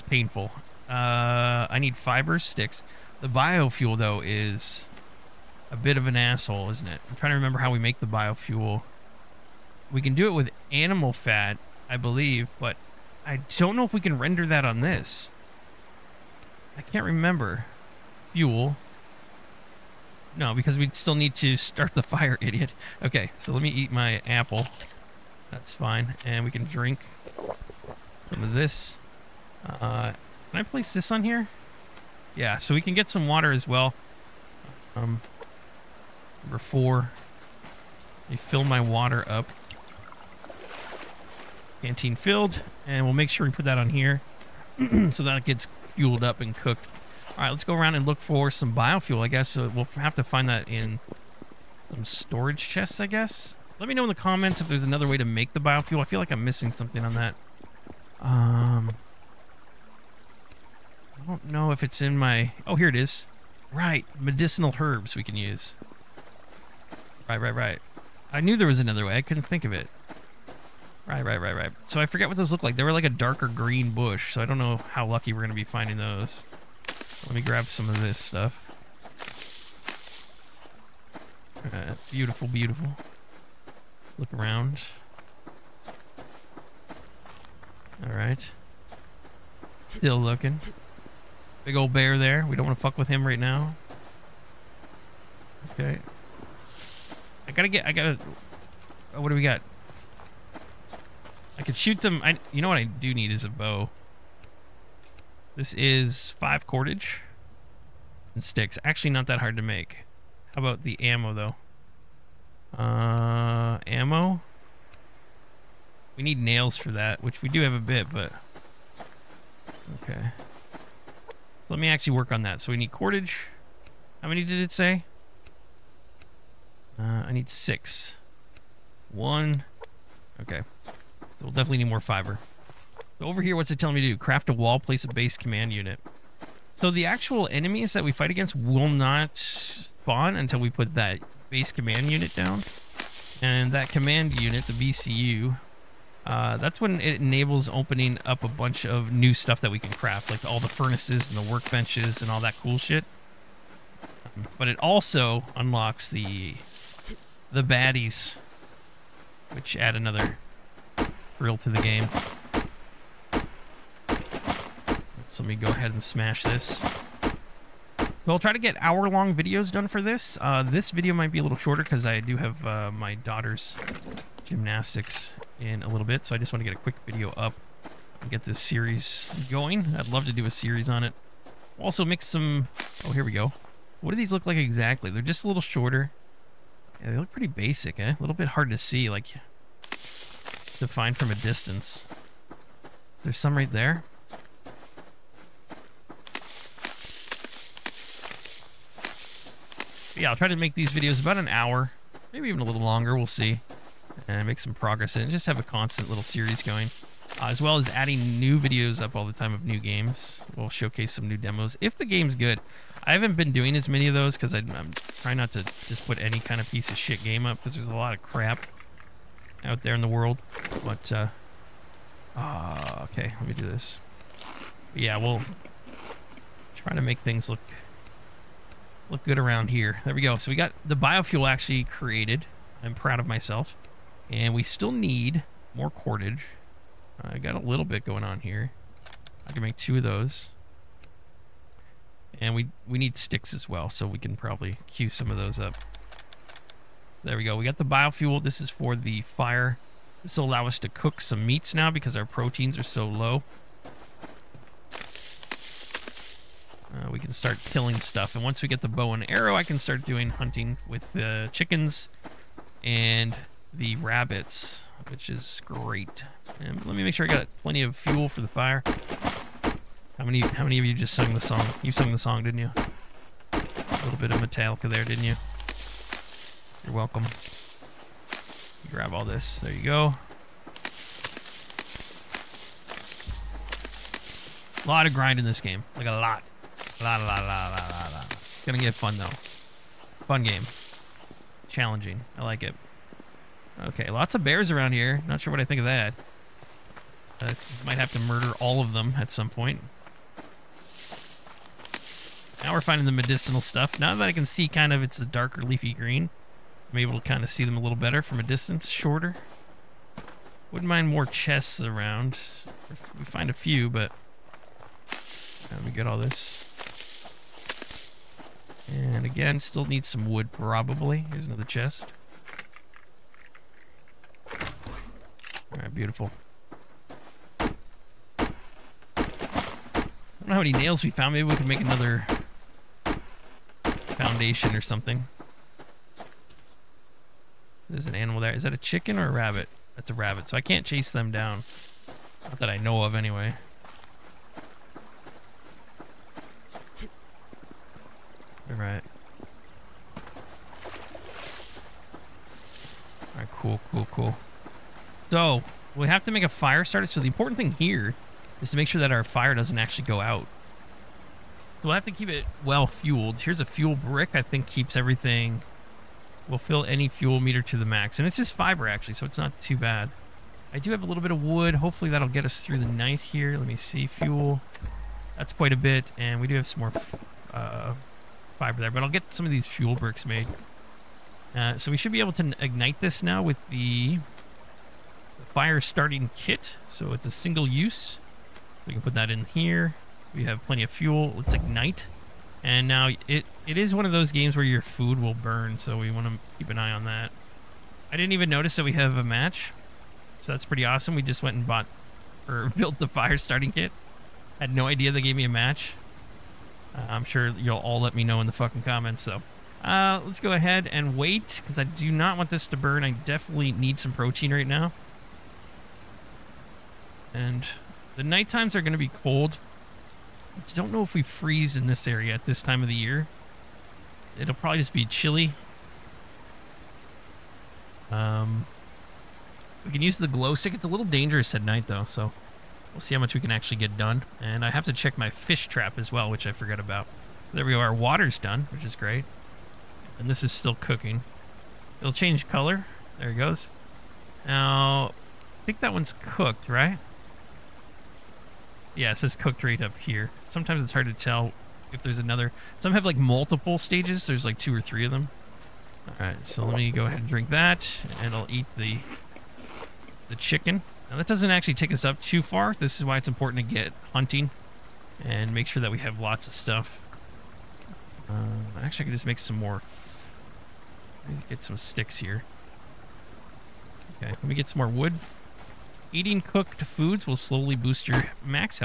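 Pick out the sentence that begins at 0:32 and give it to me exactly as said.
Yeah, so we can get some water as well.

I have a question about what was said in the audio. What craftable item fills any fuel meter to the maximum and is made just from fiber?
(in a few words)
Fuel brick.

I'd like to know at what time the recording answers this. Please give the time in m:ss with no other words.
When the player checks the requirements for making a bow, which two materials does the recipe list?
1:46.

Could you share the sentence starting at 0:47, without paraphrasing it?
All right, let's go around and look for some biofuel, I guess.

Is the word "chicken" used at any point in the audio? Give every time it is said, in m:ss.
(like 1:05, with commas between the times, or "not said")
4:21, 5:38, 7:40.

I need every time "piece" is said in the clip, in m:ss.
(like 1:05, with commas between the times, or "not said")
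3:36.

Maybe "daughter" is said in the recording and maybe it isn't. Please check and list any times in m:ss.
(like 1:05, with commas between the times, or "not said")
2:53.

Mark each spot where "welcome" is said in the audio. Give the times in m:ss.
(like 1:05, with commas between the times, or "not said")
4:36.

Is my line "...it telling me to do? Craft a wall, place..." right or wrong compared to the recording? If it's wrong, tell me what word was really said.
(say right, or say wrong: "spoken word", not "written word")
right.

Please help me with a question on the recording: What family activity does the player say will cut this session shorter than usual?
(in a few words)
Gymnastics.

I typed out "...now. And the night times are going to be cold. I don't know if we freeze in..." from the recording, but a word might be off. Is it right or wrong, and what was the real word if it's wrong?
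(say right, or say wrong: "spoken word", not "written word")
right.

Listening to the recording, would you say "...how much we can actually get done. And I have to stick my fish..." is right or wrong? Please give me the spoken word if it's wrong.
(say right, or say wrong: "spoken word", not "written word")
wrong: "check", not "stick".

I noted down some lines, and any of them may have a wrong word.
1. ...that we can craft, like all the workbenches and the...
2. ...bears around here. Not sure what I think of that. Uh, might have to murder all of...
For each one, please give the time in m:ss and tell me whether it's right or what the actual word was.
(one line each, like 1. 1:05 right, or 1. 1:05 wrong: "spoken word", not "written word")
1. 2:29 wrong: "furnaces", not "workbenches"
2. 4:54 right.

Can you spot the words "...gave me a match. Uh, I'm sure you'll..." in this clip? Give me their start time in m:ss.
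6:45.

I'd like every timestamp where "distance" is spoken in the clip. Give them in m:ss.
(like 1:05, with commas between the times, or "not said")
3:11, 5:08.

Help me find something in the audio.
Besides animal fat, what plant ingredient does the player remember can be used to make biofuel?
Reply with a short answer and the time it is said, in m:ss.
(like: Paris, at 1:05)
Medicinal herbs, at 1:04.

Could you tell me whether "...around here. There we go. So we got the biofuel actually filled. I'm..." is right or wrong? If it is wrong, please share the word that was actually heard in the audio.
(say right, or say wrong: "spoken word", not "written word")
wrong: "created", not "filled".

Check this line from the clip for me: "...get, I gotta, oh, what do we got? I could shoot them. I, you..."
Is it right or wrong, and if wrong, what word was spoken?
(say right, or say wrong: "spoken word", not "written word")
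right.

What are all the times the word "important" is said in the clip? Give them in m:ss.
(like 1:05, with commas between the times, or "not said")
5:57, 7:43.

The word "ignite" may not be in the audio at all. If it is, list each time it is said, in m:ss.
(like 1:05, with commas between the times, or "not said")
6:22, 6:31.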